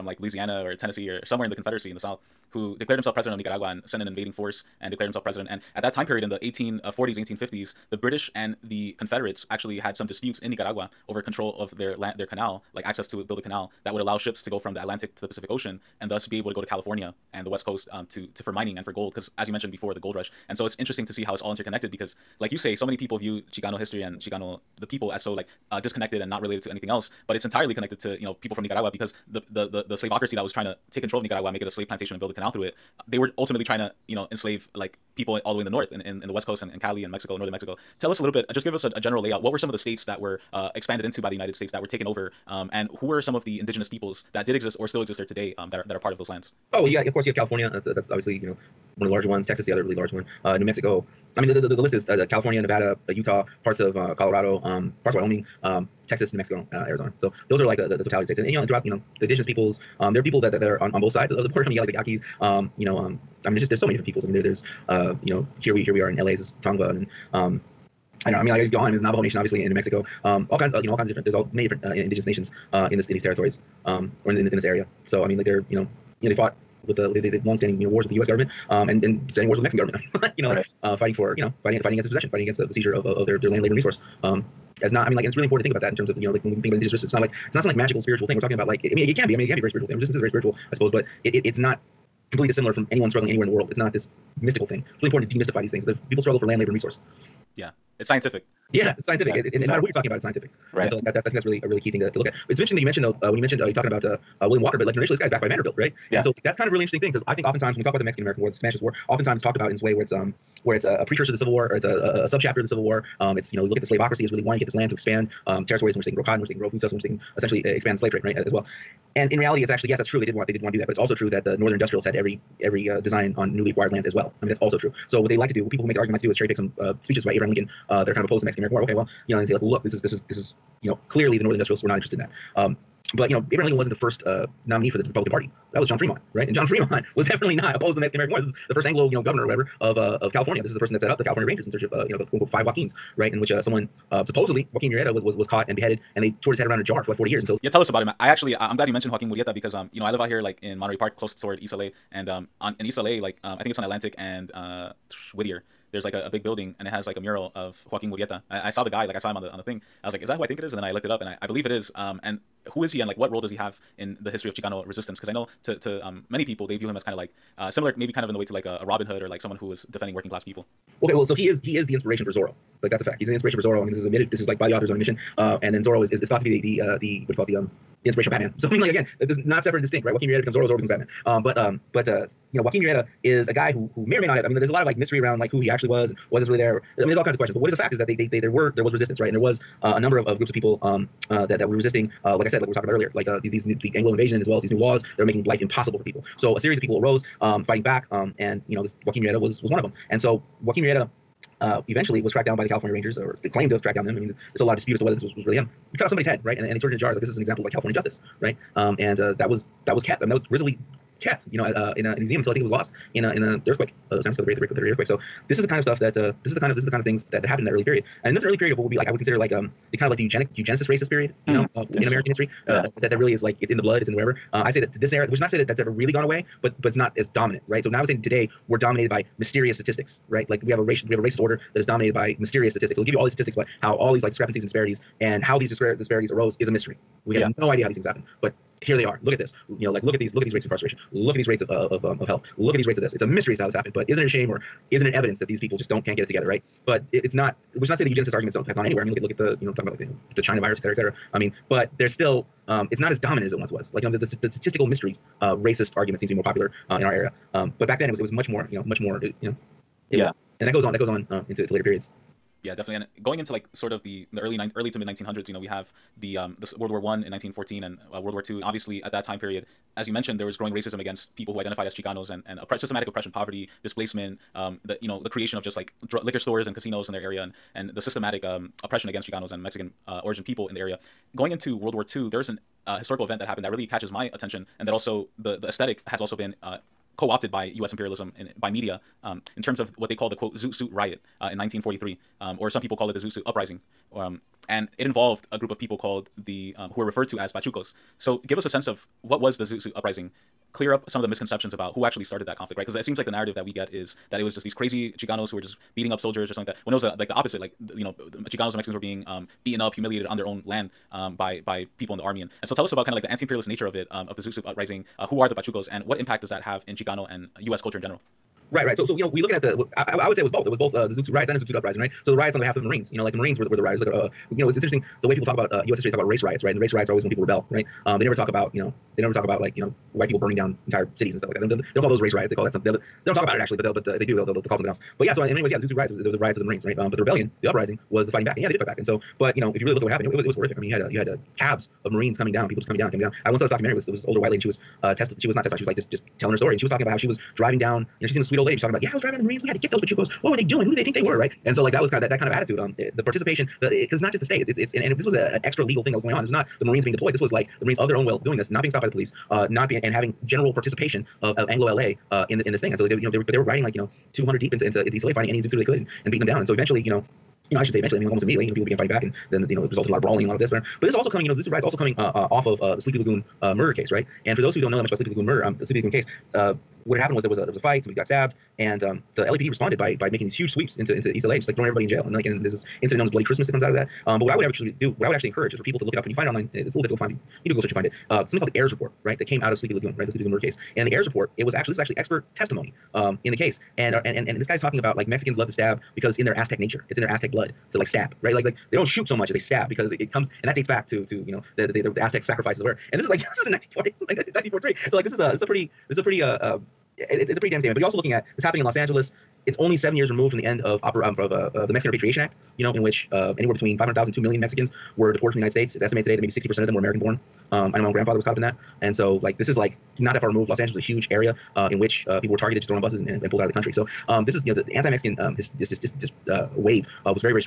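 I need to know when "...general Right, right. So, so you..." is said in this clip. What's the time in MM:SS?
05:18.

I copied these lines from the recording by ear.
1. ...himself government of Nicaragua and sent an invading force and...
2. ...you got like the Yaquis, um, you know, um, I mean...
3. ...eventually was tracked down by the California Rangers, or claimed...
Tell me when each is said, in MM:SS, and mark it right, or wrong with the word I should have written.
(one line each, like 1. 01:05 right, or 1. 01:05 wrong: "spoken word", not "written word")
1. 00:02 wrong: "president", not "government"
2. 01:01 right
3. 03:21 right.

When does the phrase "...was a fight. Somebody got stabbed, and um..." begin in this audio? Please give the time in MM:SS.
06:17.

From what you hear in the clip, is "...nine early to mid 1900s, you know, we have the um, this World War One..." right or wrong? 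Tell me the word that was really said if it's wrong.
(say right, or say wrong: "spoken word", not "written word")
right.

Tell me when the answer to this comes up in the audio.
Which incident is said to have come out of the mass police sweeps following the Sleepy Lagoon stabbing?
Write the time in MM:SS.
06:23.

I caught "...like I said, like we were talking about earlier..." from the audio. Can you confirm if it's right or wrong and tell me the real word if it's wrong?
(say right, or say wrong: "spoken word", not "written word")
right.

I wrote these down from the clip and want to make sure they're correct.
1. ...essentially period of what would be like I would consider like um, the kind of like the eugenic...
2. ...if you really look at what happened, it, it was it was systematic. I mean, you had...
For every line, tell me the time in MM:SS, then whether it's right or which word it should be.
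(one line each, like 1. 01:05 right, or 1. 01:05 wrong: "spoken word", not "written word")
1. 03:38 wrong: "early", not "essentially"
2. 05:39 wrong: "horrific", not "systematic".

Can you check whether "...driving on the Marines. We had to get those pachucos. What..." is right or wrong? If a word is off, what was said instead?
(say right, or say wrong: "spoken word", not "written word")
right.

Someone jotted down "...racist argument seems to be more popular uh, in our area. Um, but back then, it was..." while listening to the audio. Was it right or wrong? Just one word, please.
right.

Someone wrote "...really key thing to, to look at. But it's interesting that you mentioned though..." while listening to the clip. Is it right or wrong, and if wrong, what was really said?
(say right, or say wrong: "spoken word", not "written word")
right.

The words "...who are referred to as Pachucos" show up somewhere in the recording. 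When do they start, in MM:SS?
04:56.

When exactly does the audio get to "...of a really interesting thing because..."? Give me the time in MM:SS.
01:46.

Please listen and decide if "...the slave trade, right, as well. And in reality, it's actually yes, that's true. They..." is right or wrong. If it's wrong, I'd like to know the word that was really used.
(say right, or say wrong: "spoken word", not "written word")
right.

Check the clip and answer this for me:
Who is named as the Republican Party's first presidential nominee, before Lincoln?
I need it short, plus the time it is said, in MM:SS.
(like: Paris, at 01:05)
John Fremont, at 02:15.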